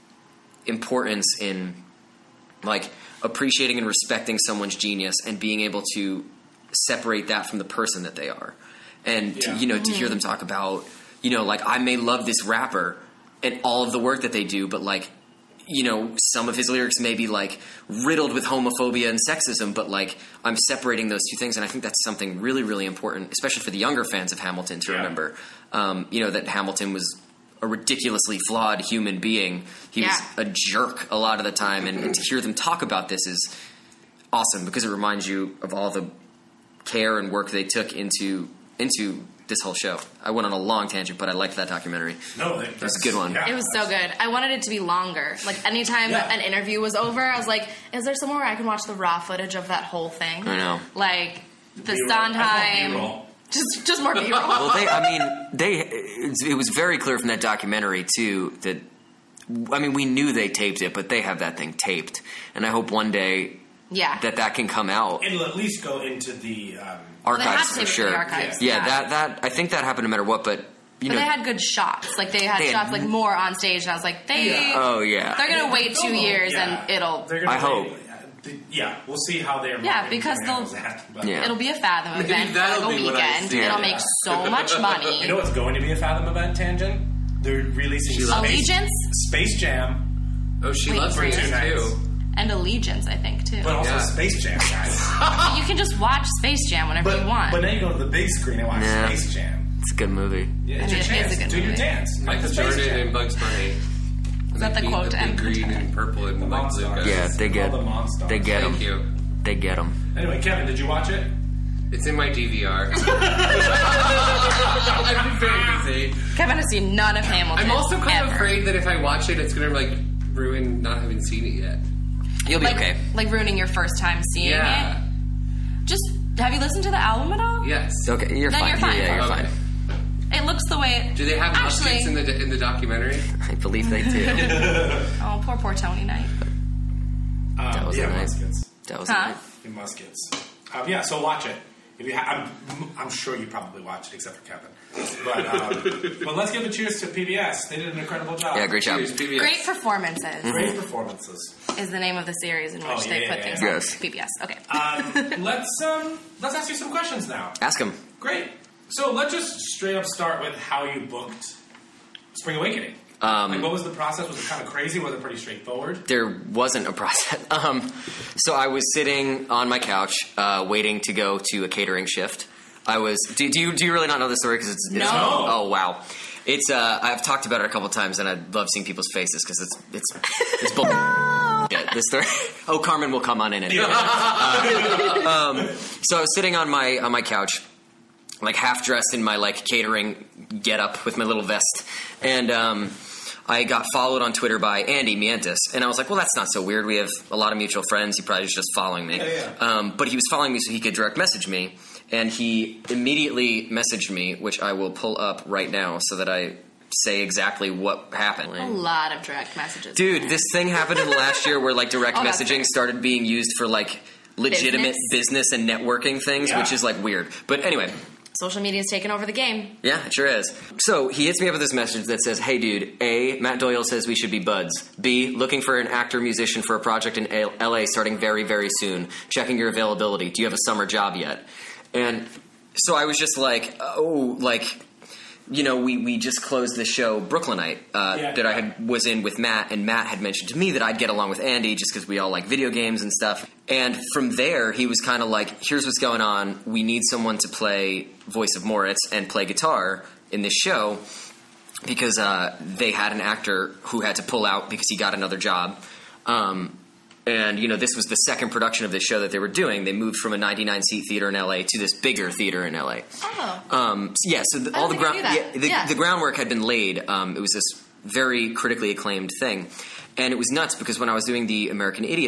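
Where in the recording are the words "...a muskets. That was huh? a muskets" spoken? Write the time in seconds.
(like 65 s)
138 s.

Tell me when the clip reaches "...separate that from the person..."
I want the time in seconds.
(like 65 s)
6 s.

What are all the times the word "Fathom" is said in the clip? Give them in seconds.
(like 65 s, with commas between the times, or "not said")
81 s, 85 s.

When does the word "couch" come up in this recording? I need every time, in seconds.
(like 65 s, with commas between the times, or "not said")
169 s, 187 s.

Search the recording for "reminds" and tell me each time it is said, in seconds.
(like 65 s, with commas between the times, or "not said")
34 s.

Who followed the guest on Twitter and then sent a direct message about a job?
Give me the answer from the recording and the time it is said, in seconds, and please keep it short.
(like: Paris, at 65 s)
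Andy Mientus, at 194 s.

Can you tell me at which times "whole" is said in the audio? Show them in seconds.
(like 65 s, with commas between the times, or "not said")
39 s, 49 s.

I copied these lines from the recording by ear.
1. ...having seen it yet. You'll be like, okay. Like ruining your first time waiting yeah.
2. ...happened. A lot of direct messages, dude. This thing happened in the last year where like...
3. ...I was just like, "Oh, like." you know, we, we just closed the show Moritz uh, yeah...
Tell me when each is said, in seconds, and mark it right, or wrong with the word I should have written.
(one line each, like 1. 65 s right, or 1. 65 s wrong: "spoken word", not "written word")
1. 121 s wrong: "seeing", not "waiting"
2. 208 s right
3. 232 s wrong: "Brooklynite", not "Moritz".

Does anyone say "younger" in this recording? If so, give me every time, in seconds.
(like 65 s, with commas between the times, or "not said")
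23 s.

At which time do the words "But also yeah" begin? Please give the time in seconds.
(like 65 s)
93 s.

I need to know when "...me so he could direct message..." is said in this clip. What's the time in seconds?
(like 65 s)
200 s.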